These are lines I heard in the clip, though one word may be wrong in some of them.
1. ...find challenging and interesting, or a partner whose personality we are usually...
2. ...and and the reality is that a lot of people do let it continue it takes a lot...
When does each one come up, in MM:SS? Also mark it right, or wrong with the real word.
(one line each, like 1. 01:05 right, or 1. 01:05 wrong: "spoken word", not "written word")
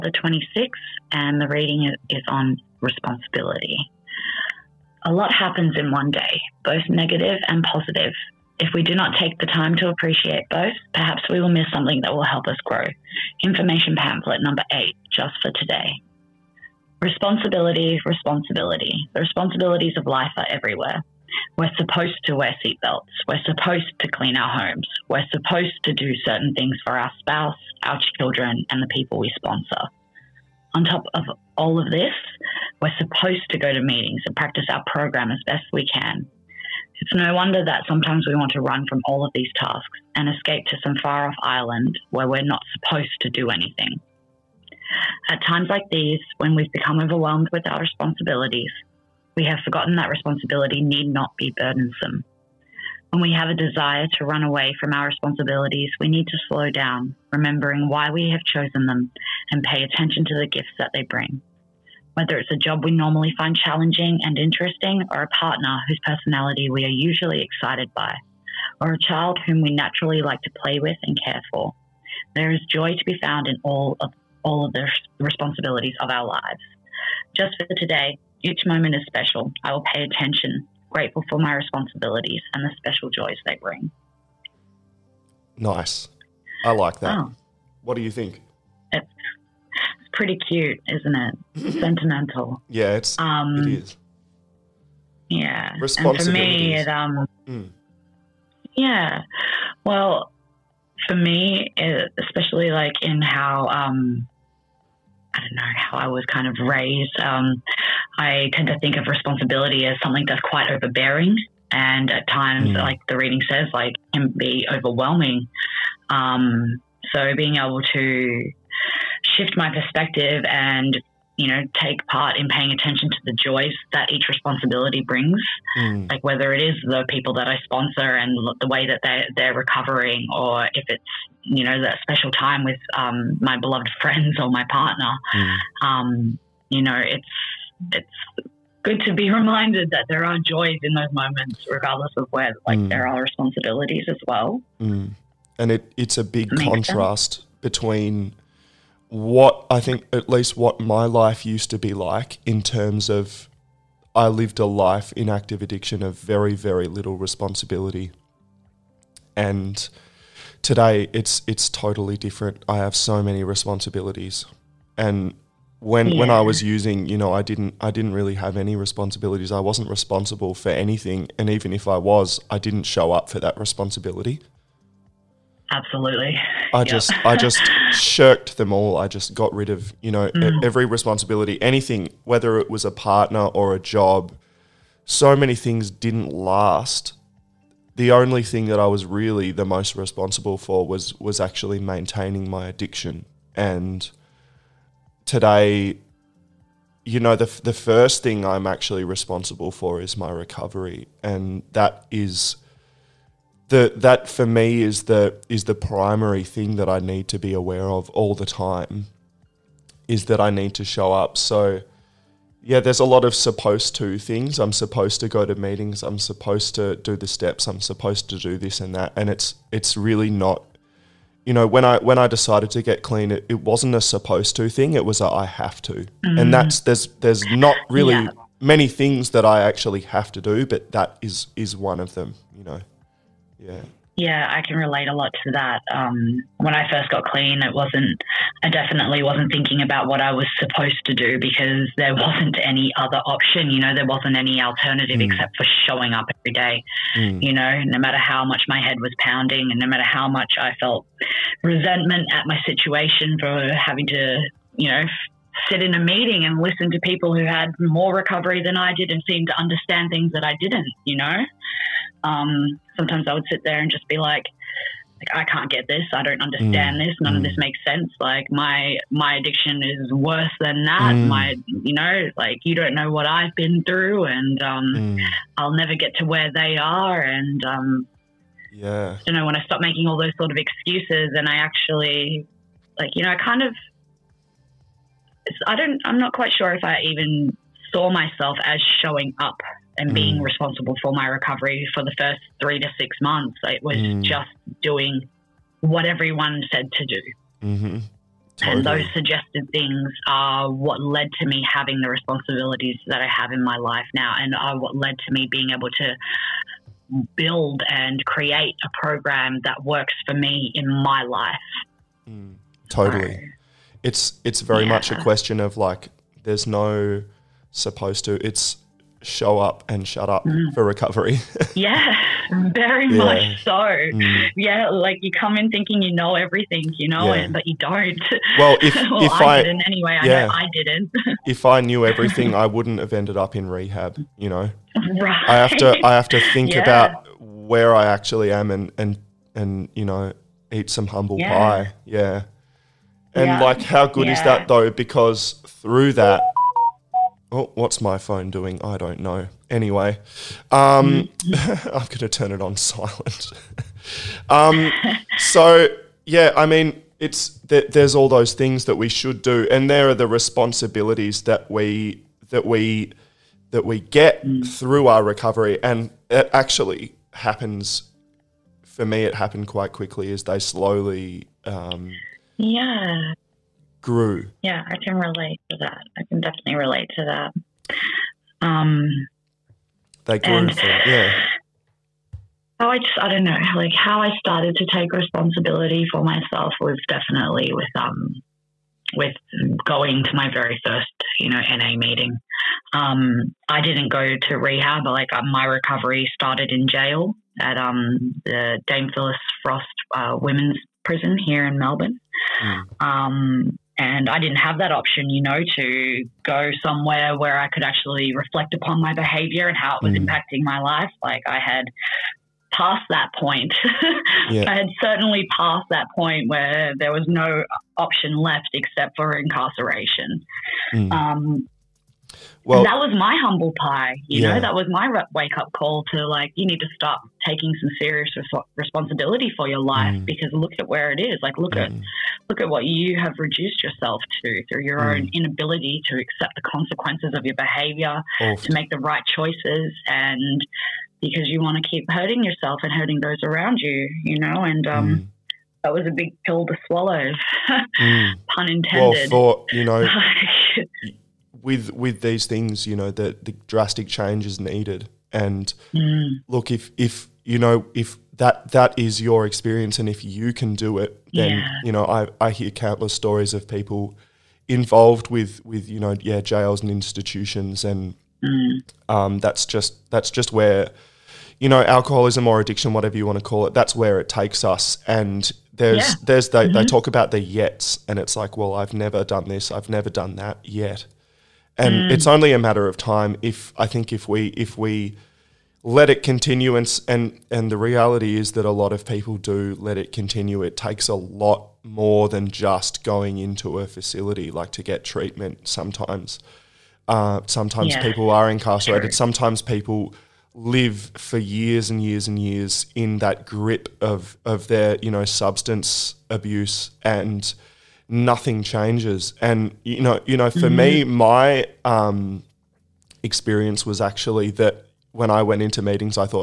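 1. 01:03 right
2. 08:07 right.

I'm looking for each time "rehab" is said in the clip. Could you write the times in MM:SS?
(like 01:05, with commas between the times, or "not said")
05:33, 06:34.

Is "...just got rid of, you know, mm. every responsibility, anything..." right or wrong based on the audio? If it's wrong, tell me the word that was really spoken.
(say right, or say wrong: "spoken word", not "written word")
right.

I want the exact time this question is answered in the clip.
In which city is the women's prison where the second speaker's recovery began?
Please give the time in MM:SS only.
06:41.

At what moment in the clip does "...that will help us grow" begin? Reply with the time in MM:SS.
00:12.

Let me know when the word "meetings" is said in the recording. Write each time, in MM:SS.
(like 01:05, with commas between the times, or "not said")
00:33, 03:35, 04:16, 06:31, 08:35.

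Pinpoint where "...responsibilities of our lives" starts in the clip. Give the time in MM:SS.
01:15.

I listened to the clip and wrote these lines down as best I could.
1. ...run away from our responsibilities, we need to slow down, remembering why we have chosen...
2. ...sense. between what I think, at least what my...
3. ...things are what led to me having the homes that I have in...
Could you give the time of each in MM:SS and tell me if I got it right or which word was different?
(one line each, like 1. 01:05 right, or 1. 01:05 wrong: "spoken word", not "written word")
1. 00:54 right
2. 02:27 right
3. 04:59 wrong: "responsibilities", not "homes".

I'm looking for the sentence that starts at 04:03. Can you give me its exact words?
You know, there wasn't any alternative mm.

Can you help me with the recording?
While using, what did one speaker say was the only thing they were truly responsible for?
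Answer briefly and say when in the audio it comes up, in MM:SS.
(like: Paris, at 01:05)
Maintaining my addiction, at 03:11.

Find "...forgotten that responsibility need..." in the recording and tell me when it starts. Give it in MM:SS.
00:49.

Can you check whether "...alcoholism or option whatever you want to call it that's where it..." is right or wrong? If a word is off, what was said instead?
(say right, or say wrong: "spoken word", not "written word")
wrong: "addiction", not "option".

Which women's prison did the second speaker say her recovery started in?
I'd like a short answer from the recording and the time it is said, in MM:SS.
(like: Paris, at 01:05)
Dame Phyllis Frost, at 06:38.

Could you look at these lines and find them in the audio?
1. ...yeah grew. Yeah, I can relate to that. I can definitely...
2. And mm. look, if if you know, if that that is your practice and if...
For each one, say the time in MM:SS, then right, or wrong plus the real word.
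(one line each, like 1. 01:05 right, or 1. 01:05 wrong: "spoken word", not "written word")
1. 06:12 right
2. 07:35 wrong: "experience", not "practice".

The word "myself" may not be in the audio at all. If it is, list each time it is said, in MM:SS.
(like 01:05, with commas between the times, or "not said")
04:48, 06:26.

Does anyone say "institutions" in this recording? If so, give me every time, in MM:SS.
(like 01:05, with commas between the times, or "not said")
07:46.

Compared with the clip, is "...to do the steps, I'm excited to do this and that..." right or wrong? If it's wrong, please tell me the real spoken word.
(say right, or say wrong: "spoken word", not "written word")
wrong: "supposed", not "excited".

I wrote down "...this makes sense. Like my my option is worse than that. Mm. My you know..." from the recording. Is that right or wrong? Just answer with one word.
wrong.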